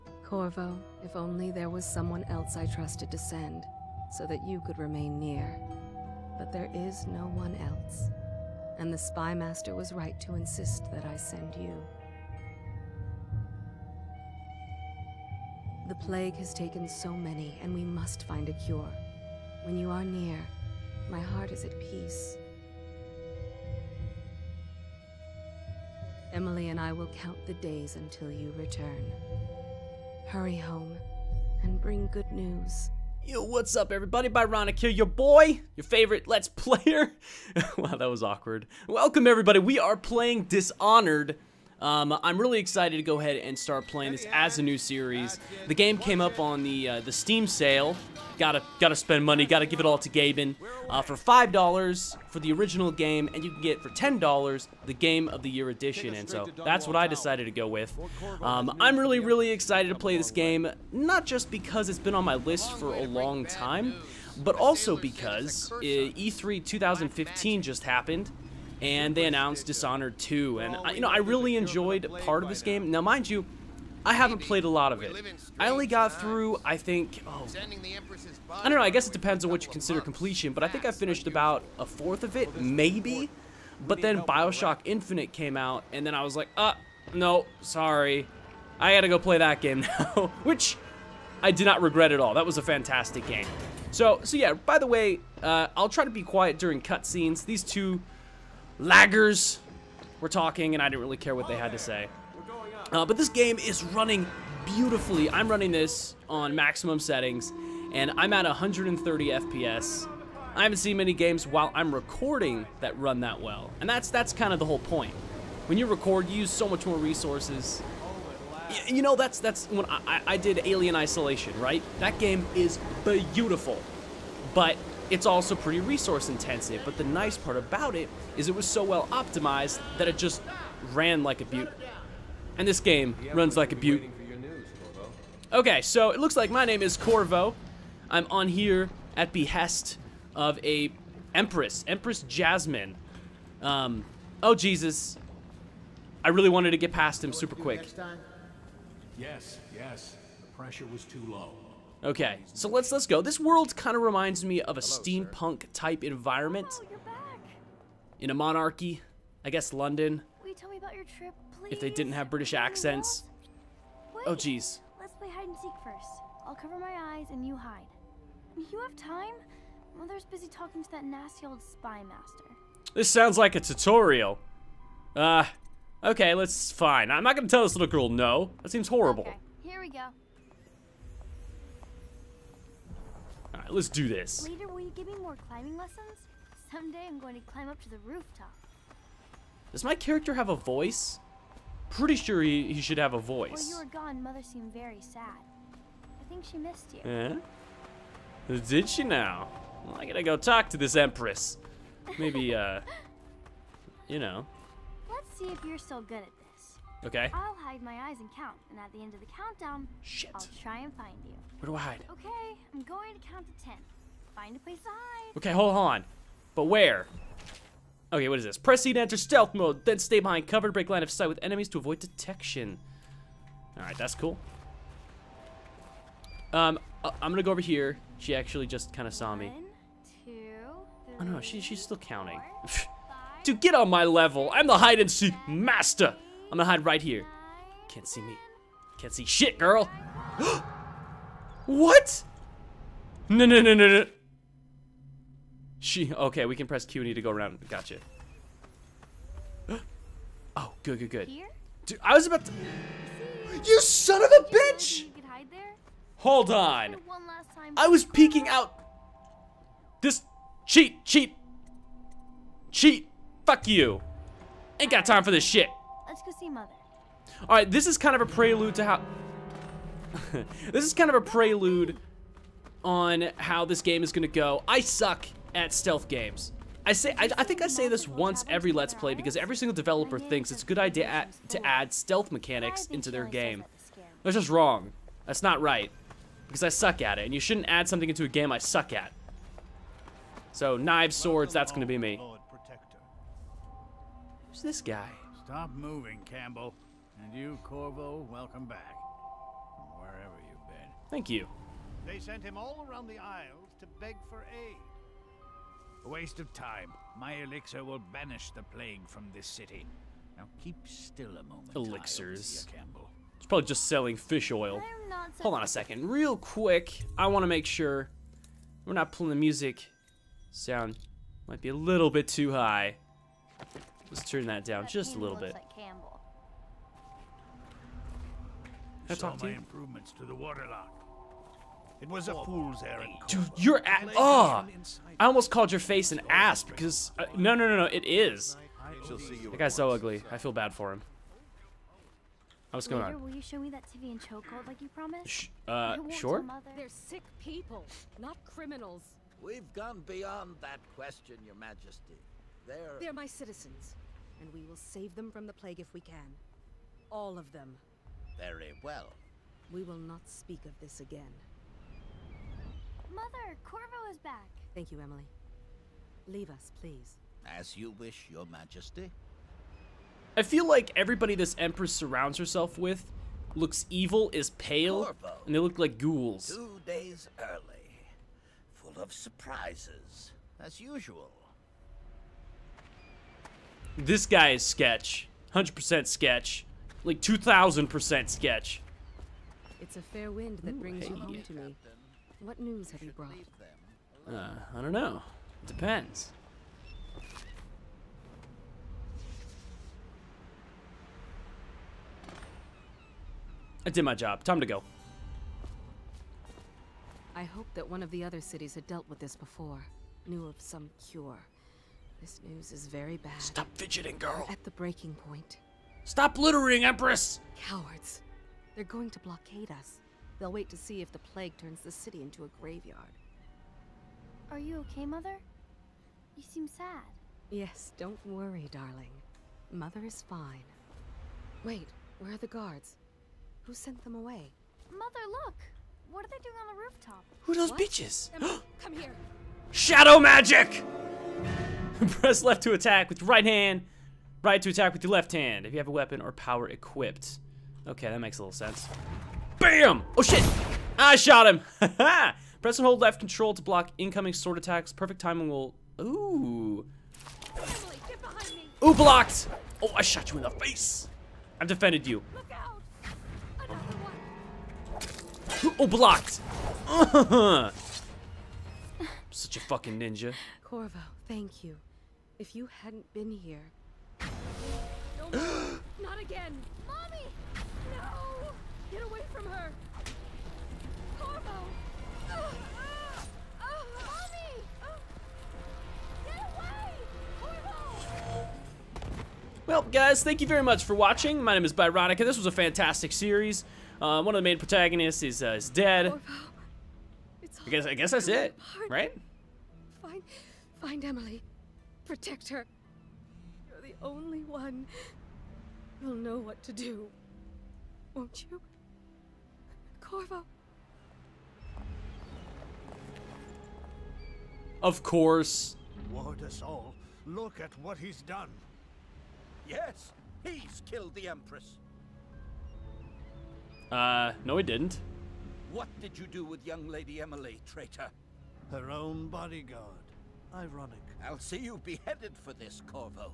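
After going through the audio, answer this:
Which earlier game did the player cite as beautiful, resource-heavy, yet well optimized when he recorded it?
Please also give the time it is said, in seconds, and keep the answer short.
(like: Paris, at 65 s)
Alien Isolation, at 120 s.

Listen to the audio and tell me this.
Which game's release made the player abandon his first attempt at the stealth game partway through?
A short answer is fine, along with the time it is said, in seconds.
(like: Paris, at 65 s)
Bioshock Infinite, at 84 s.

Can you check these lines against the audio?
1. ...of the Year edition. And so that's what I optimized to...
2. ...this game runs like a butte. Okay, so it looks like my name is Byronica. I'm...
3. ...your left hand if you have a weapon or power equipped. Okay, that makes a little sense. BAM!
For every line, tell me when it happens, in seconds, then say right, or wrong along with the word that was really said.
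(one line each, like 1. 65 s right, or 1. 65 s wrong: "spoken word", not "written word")
1. 55 s wrong: "decided", not "optimized"
2. 132 s wrong: "Corvo", not "Byronica"
3. 445 s right.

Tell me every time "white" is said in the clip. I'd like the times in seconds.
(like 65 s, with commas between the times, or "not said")
not said.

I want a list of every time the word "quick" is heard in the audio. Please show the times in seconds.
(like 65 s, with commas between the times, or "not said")
147 s, 316 s.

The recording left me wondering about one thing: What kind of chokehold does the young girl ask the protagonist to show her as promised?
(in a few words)
Tyvian chokehold.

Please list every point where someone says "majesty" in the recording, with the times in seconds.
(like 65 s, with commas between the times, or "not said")
351 s, 368 s.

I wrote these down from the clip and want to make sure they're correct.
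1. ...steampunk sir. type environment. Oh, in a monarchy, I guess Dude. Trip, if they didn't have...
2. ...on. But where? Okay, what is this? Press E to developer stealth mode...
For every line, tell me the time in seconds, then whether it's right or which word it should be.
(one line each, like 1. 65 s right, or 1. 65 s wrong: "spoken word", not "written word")
1. 154 s wrong: "London", not "Dude"
2. 215 s wrong: "enter", not "developer".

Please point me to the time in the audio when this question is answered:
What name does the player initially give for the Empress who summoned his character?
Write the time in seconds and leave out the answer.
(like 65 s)
141 s.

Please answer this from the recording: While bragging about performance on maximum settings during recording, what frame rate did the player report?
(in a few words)
130 FPS.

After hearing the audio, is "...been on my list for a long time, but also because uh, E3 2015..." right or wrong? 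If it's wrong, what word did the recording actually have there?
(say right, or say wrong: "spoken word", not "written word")
right.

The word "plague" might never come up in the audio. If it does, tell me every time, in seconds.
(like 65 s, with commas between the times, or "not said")
15 s, 308 s, 355 s, 421 s.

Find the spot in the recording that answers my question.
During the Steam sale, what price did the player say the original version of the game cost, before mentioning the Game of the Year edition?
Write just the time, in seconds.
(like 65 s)
51 s.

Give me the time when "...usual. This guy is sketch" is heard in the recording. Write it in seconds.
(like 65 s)
380 s.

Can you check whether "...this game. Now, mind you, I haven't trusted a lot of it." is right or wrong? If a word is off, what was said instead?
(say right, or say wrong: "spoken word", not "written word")
wrong: "played", not "trusted".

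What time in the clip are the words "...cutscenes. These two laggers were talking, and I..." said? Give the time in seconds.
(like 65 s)
96 s.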